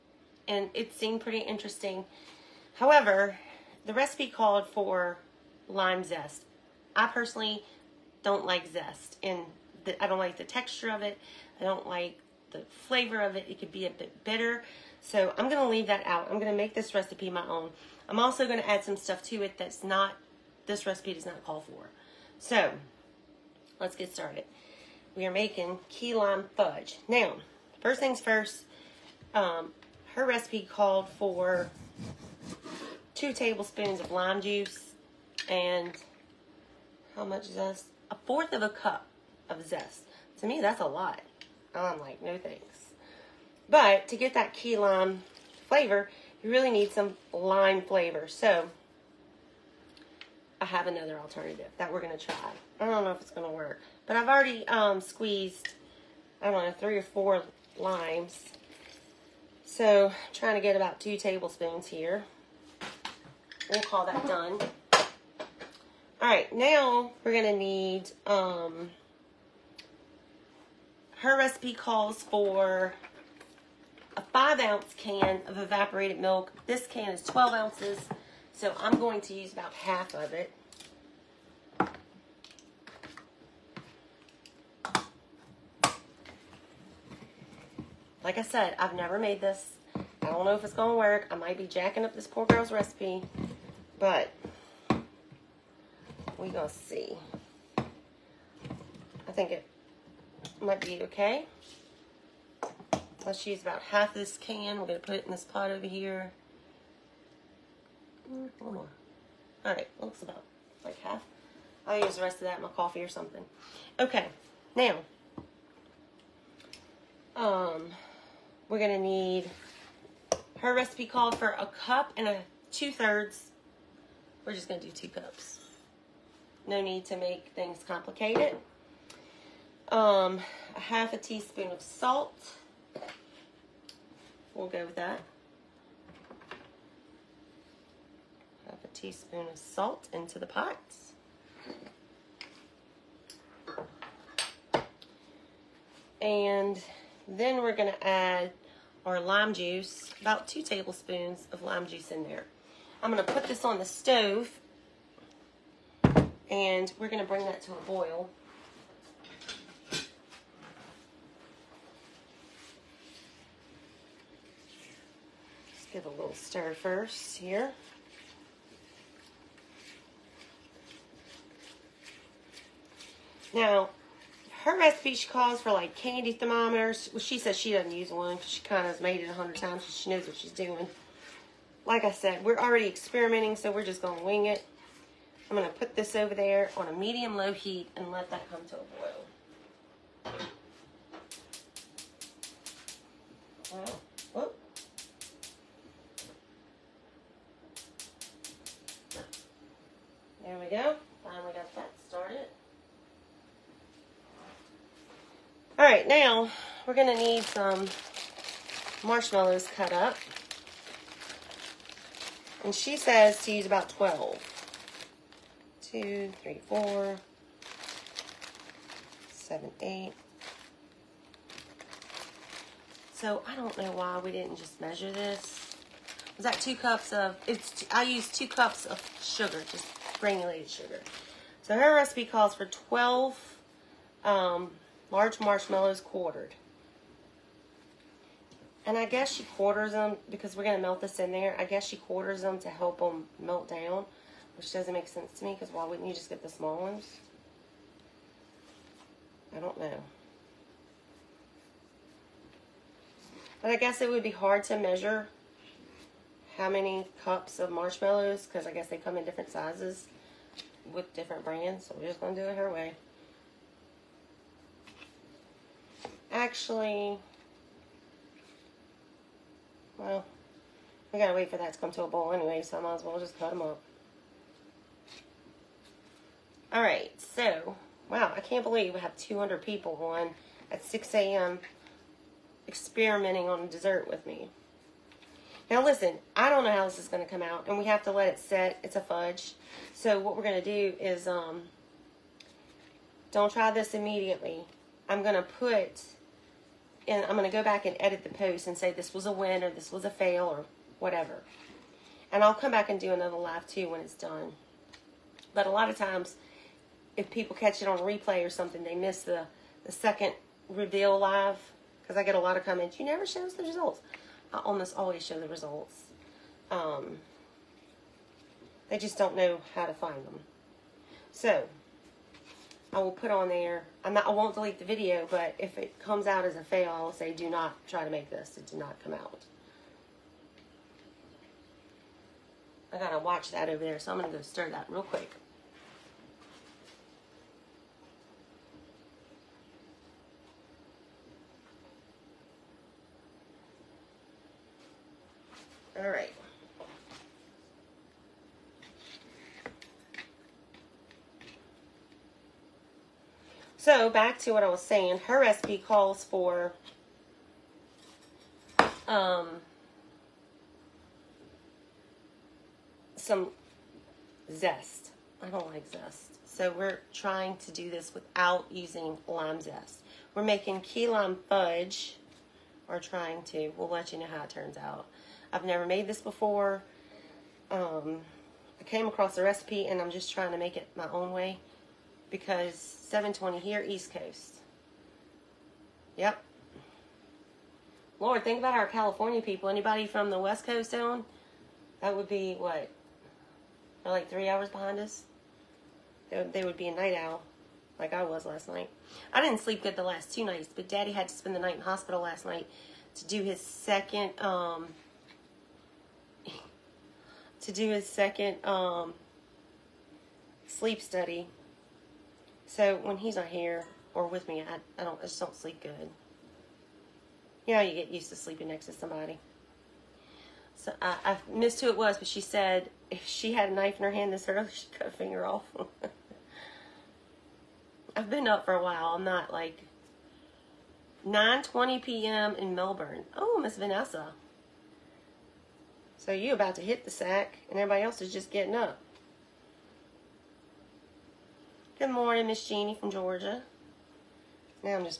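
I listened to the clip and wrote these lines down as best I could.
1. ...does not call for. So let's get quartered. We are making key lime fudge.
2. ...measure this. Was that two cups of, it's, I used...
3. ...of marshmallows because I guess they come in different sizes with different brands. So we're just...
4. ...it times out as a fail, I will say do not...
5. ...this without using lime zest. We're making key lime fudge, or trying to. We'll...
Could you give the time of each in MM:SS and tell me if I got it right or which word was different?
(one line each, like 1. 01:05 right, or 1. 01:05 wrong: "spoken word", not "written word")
1. 00:21 wrong: "started", not "quartered"
2. 03:44 right
3. 04:17 right
4. 05:25 wrong: "comes", not "times"
5. 06:07 right.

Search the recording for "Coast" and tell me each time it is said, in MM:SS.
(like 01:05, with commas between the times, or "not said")
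06:24, 06:30.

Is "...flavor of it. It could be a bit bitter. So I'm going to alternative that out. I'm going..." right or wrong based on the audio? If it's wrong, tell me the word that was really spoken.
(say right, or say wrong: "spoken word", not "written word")
wrong: "leave", not "alternative".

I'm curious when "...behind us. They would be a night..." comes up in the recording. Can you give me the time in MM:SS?
06:34.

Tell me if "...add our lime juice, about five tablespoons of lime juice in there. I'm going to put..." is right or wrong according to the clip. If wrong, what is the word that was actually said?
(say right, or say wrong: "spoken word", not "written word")
wrong: "two", not "five".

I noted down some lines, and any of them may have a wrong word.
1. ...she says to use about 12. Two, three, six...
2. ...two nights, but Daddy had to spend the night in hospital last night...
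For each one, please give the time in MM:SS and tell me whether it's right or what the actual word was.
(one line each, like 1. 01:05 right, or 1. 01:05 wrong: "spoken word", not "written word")
1. 03:32 wrong: "four", not "six"
2. 06:40 right.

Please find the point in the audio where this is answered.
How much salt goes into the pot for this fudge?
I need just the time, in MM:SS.
02:10.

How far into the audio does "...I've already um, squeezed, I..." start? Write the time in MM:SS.
00:54.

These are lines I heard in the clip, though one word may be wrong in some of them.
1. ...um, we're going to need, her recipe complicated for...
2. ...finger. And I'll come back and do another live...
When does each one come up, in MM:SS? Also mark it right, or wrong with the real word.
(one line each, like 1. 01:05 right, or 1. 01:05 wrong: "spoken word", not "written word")
1. 01:57 wrong: "called", not "complicated"
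2. 05:01 wrong: "whatever", not "finger".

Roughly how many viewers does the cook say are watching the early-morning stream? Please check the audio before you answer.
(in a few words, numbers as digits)
200.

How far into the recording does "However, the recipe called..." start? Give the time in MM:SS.
00:02.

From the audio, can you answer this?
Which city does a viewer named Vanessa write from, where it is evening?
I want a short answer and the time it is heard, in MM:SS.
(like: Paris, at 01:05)
Melbourne, at 07:12.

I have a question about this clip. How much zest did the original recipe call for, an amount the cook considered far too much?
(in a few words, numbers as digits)
1/4 cup.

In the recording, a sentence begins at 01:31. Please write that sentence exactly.
I might be jacking up this poor girl's recipe, but we're going to see.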